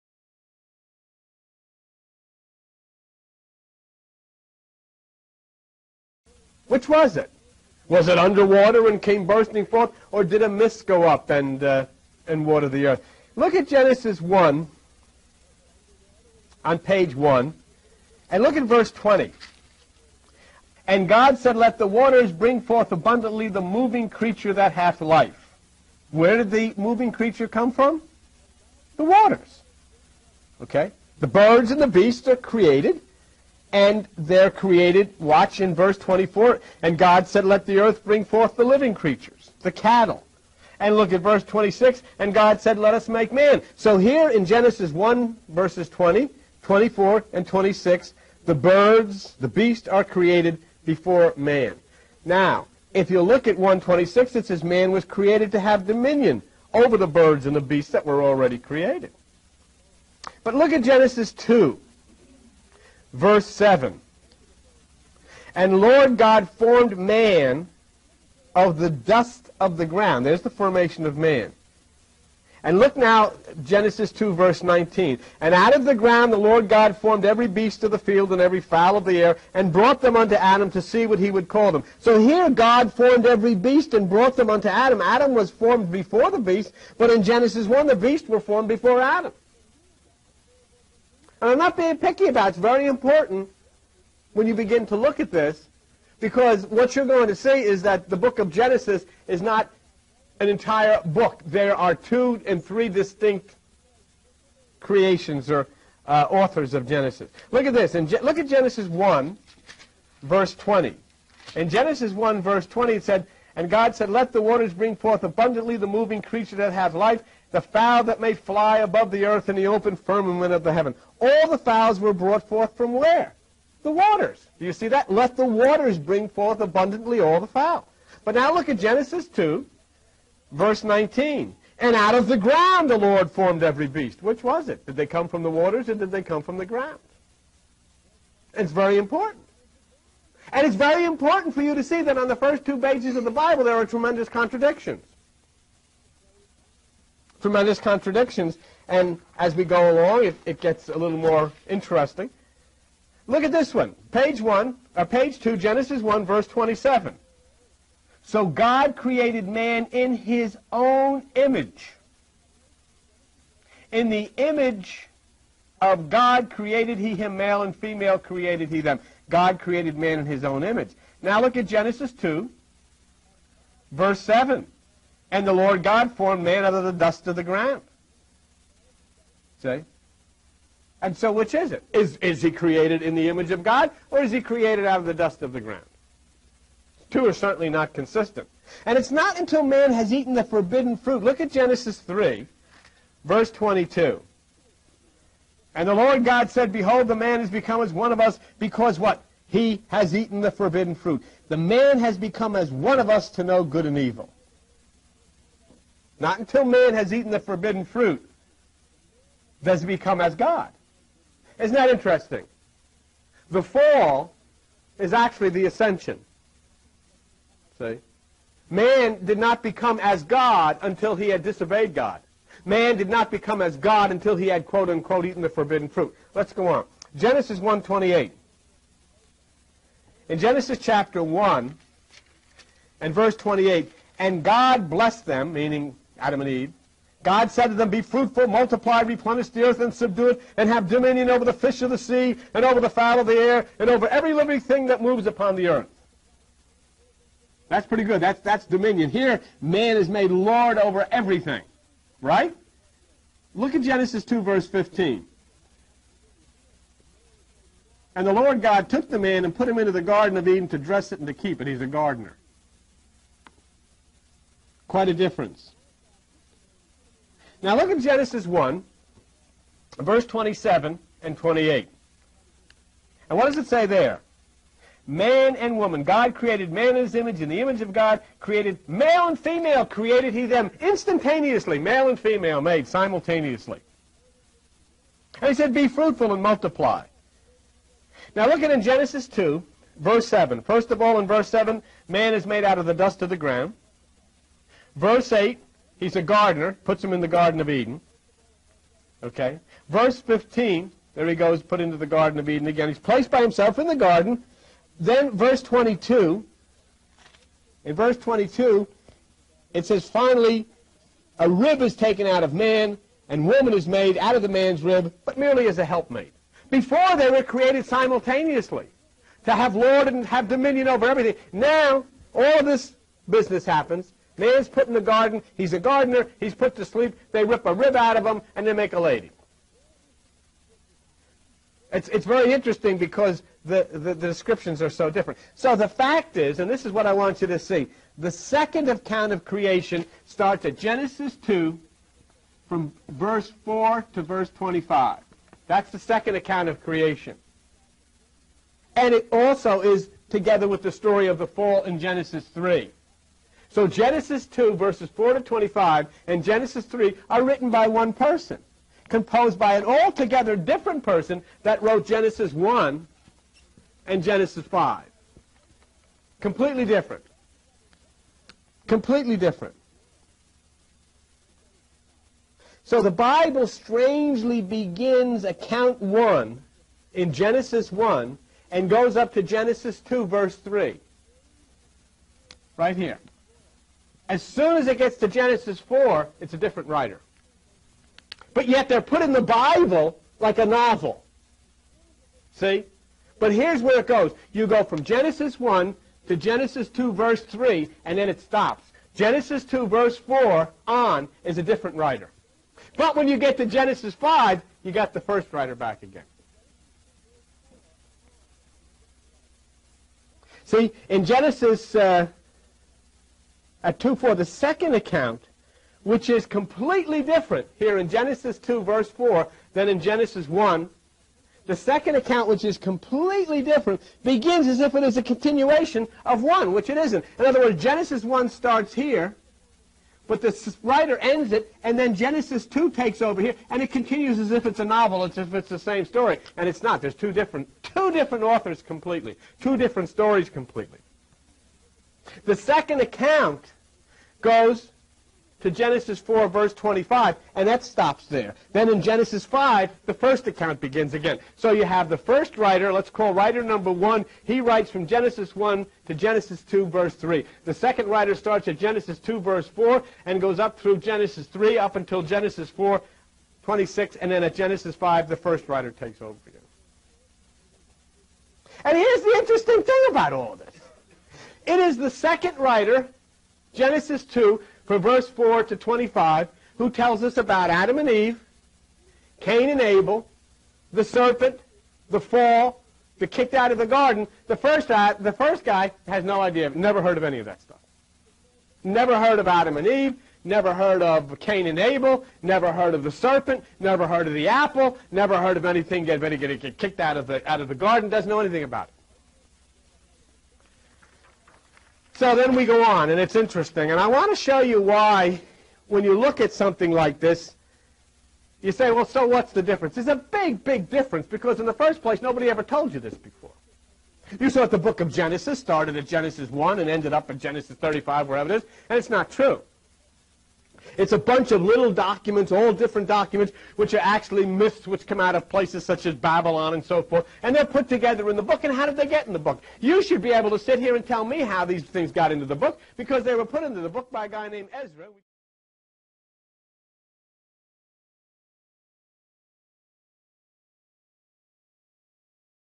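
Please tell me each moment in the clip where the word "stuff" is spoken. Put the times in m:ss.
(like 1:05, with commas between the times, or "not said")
8:07.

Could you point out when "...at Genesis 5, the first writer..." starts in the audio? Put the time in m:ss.
7:44.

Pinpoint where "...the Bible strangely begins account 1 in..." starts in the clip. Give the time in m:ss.
6:13.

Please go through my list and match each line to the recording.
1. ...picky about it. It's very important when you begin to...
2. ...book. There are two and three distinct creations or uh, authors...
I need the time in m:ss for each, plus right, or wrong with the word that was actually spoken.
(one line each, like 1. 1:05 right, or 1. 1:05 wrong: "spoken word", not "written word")
1. 1:31 right
2. 1:41 right.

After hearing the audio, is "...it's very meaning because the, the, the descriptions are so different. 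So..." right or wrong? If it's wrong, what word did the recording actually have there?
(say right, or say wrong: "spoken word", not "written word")
wrong: "interesting", not "meaning".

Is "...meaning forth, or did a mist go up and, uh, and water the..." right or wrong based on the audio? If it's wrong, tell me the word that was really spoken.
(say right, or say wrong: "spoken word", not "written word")
wrong: "bursting", not "meaning".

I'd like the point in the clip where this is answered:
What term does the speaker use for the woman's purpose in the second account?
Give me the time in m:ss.
5:15.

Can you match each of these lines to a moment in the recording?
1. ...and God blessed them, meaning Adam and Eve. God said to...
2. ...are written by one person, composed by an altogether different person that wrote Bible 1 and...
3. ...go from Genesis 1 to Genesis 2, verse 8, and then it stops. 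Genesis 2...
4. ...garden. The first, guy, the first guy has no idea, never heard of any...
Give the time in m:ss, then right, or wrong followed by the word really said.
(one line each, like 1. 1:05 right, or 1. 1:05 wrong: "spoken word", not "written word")
1. 3:54 right
2. 5:57 wrong: "Genesis", not "Bible"
3. 6:34 wrong: "3", not "8"
4. 8:03 right.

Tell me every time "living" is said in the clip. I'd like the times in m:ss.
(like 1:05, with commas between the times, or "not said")
0:38, 4:04.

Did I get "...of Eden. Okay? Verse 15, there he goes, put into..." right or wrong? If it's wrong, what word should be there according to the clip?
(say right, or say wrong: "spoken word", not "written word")
right.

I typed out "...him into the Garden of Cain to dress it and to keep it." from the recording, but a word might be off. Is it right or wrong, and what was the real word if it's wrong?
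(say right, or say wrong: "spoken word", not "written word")
wrong: "Eden", not "Cain".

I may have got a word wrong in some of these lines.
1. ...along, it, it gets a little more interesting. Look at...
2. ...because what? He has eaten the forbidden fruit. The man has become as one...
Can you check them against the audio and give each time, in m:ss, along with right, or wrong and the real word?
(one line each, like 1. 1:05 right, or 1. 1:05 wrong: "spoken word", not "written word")
1. 2:29 right
2. 3:18 right.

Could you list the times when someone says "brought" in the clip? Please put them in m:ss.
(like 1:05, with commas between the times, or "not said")
1:19, 1:24, 2:02.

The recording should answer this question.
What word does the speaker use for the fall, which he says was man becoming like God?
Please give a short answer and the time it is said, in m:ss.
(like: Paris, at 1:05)
The ascension, at 3:35.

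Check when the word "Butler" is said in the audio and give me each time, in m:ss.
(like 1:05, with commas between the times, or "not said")
not said.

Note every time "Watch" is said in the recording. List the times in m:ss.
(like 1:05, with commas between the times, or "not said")
0:35.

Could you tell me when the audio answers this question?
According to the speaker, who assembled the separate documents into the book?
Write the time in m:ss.
8:54.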